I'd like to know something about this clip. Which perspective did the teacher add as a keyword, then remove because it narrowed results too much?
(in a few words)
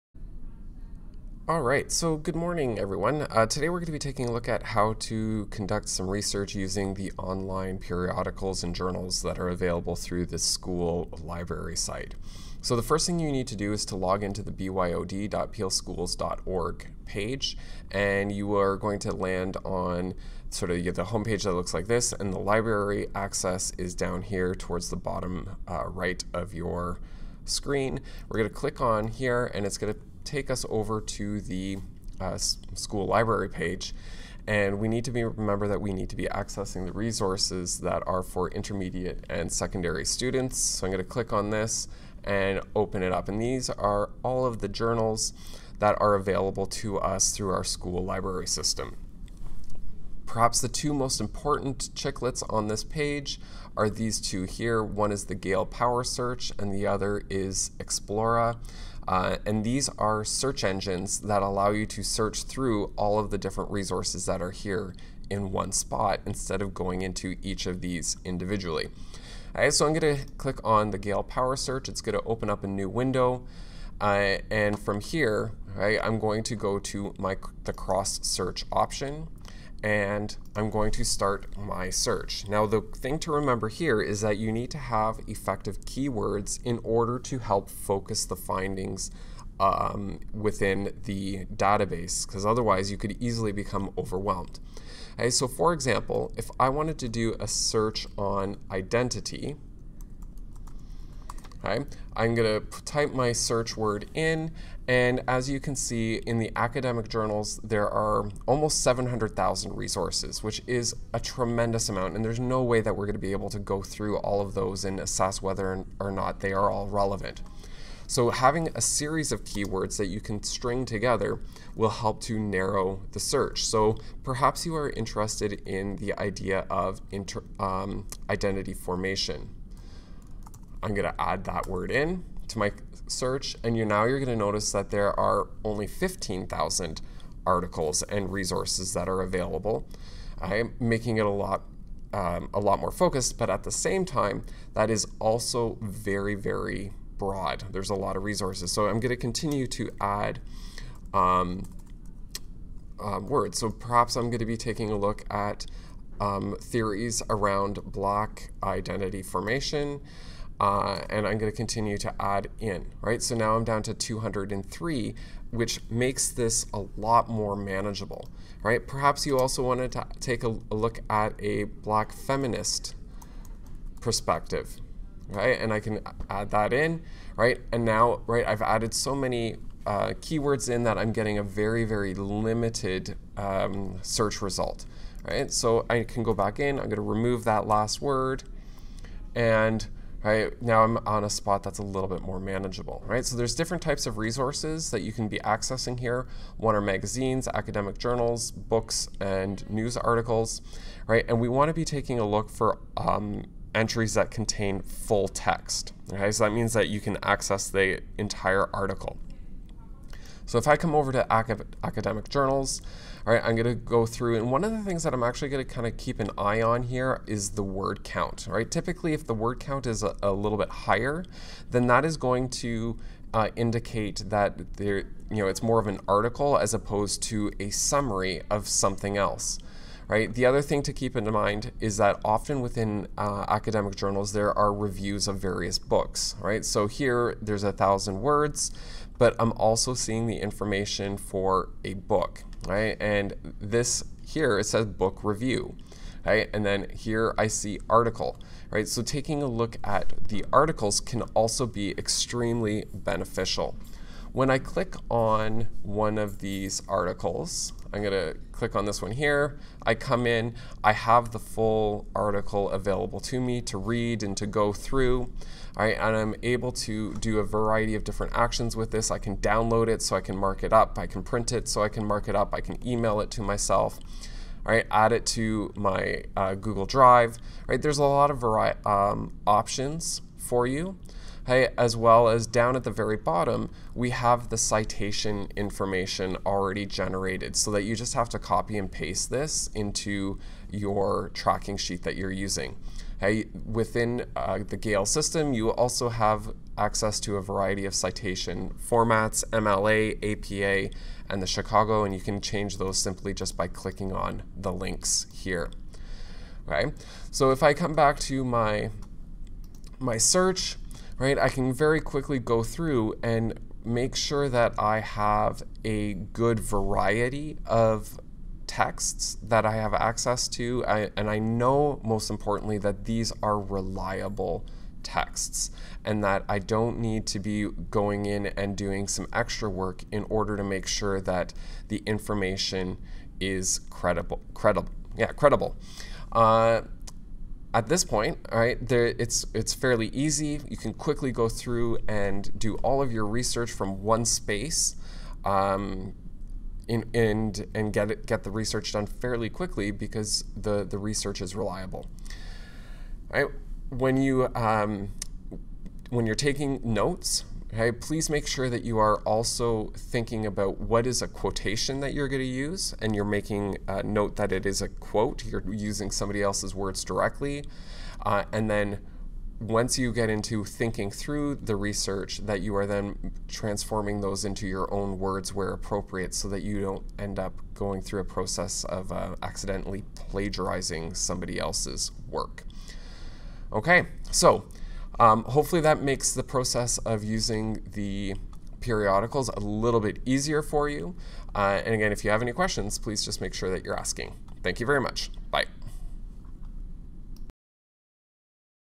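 black feminist perspective.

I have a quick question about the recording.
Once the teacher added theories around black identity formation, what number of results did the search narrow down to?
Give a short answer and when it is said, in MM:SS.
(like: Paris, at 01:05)
203, at 02:43.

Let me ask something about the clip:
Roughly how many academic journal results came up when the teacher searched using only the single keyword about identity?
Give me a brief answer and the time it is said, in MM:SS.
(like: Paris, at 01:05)
700,000, at 01:48.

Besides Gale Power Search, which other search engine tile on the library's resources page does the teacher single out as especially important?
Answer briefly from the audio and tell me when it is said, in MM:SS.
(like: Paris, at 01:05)
Explora, at 00:57.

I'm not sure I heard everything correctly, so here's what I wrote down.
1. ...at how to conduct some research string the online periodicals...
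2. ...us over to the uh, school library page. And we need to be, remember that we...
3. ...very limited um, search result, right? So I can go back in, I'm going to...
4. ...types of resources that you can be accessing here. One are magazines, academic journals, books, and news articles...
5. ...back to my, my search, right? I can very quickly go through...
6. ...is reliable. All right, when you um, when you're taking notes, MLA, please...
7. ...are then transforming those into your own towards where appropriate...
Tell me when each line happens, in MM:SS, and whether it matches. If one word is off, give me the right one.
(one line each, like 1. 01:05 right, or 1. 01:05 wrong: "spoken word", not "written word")
1. 00:04 wrong: "using", not "string"
2. 00:30 right
3. 03:01 right
4. 03:13 right
5. 05:07 right
6. 05:51 wrong: "Okay", not "MLA"
7. 06:12 wrong: "words", not "towards".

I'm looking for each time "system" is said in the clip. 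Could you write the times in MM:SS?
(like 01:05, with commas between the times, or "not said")
00:48, 04:55.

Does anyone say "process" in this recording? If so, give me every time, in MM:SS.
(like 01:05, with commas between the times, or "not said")
06:18, 06:26.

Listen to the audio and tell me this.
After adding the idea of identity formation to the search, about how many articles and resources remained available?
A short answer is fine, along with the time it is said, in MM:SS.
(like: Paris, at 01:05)
15,000, at 02:15.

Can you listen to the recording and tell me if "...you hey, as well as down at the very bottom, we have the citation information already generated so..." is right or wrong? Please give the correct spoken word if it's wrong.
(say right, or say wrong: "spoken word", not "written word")
right.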